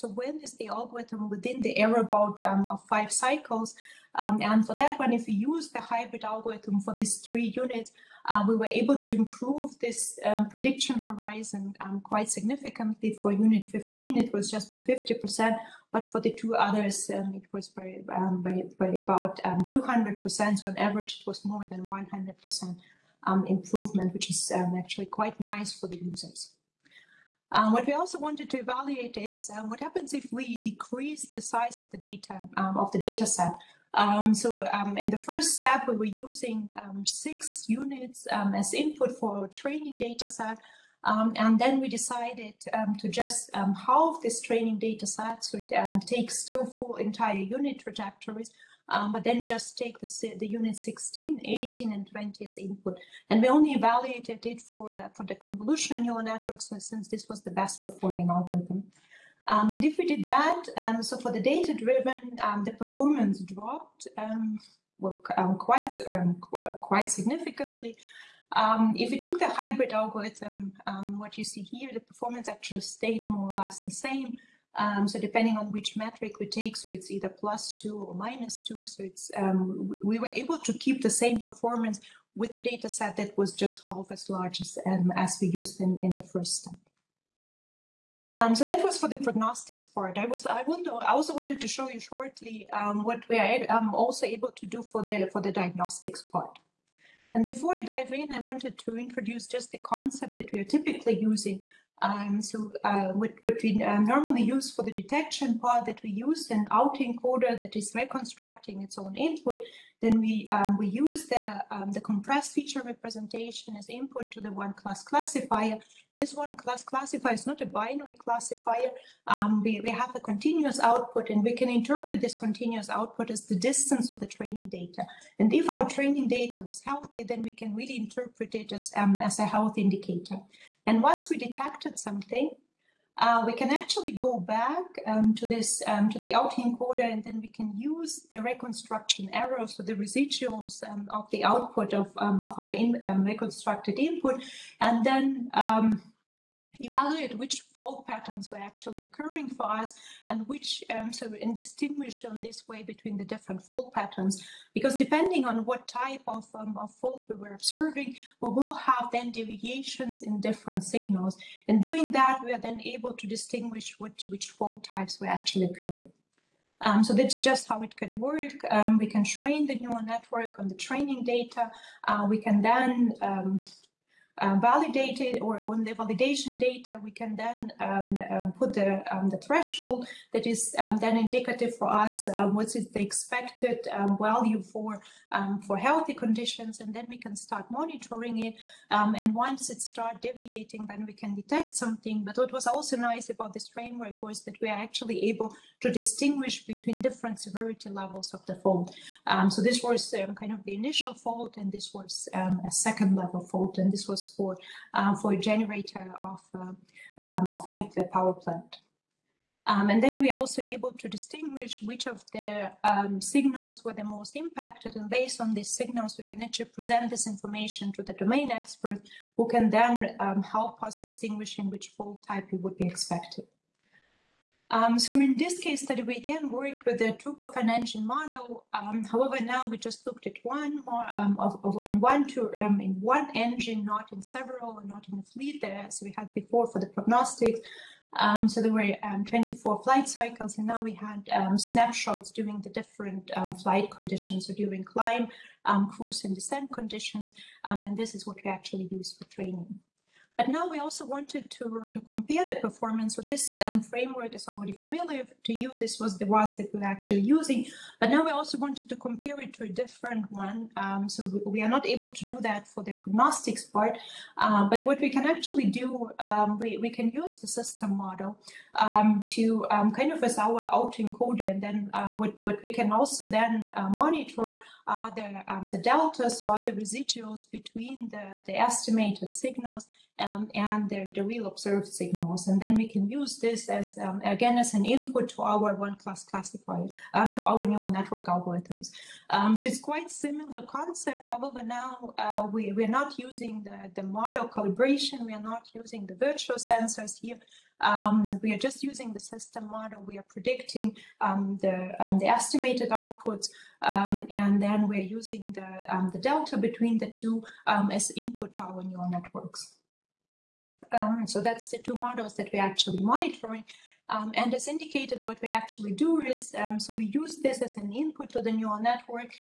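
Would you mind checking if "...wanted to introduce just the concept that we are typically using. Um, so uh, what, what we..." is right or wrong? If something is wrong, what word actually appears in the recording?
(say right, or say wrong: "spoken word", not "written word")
right.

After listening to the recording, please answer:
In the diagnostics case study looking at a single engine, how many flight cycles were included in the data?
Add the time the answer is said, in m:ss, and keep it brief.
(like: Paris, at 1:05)
24, at 3:59.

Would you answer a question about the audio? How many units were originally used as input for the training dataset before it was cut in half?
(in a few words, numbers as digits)
6.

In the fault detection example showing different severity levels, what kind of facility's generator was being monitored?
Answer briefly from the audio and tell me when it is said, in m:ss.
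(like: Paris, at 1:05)
nuclear power plant, at 3:27.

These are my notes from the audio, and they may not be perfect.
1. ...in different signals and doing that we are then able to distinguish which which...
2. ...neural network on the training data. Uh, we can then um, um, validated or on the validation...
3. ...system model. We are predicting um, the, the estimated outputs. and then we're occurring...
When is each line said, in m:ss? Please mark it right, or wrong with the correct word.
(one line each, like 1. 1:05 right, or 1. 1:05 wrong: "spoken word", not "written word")
1. 2:40 right
2. 2:49 right
3. 4:59 wrong: "using", not "occurring".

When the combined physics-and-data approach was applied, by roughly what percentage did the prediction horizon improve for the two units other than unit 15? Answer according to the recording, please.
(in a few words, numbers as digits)
200%.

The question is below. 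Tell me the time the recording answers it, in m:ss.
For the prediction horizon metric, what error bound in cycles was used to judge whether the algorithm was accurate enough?
0:02.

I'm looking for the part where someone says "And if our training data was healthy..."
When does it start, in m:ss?
2:05.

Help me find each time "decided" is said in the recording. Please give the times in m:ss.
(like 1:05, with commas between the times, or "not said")
0:41.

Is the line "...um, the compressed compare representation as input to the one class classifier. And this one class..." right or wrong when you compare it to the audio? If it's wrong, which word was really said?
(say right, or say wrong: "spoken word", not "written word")
wrong: "feature", not "compare".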